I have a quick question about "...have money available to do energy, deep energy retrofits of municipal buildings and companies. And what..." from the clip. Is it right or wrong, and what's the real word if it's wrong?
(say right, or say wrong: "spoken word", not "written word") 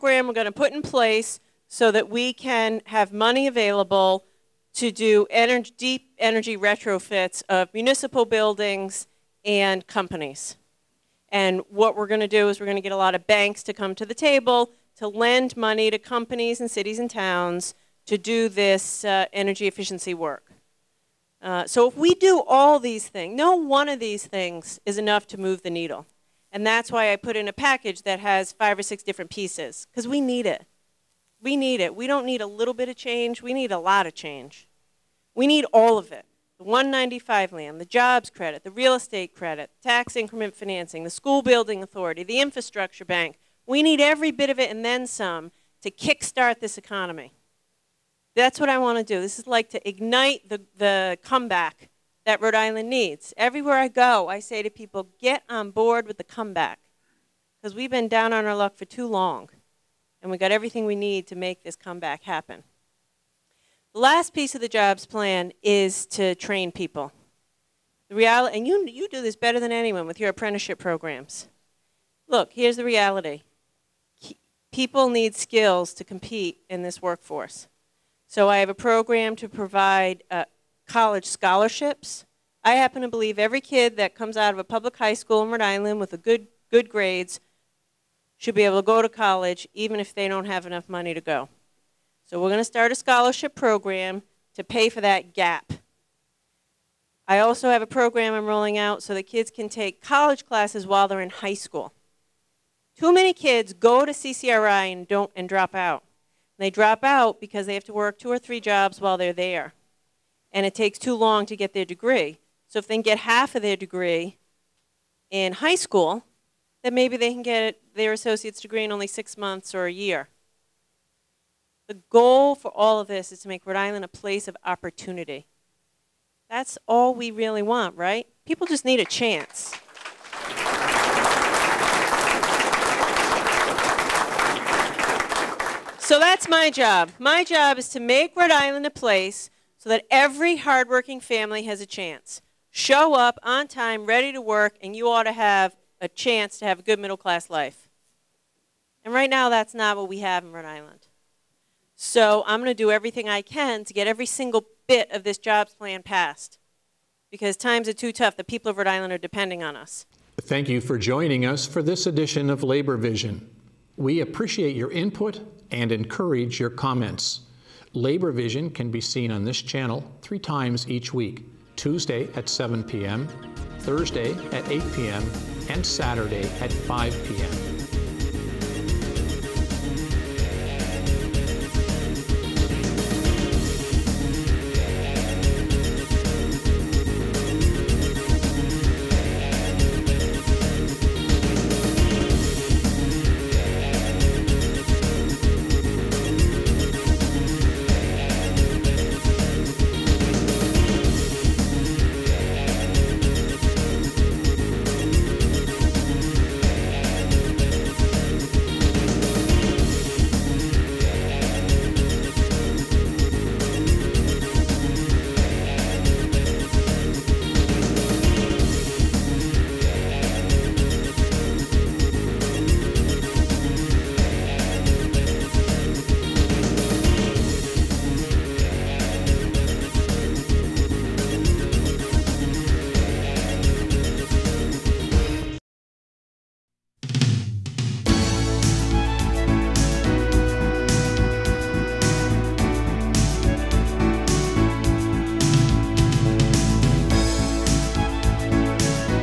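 right.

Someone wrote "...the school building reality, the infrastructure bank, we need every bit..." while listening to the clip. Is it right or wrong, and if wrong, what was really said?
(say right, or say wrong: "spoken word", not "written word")
wrong: "authority", not "reality".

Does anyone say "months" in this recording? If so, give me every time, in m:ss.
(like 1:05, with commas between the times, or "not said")
1:59.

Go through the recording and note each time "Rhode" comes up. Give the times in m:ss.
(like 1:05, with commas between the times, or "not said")
0:52, 1:25, 2:03, 2:18, 2:30, 2:38.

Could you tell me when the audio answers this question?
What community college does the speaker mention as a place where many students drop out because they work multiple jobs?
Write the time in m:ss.
1:44.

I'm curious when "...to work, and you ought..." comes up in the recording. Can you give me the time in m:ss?
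2:24.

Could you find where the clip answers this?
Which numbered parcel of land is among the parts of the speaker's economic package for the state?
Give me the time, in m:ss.
0:36.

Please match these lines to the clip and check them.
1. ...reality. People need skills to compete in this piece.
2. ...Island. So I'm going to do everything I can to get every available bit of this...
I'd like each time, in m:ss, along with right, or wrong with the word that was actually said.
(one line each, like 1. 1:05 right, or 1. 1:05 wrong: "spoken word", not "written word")
1. 1:12 wrong: "workforce", not "piece"
2. 2:30 wrong: "single", not "available".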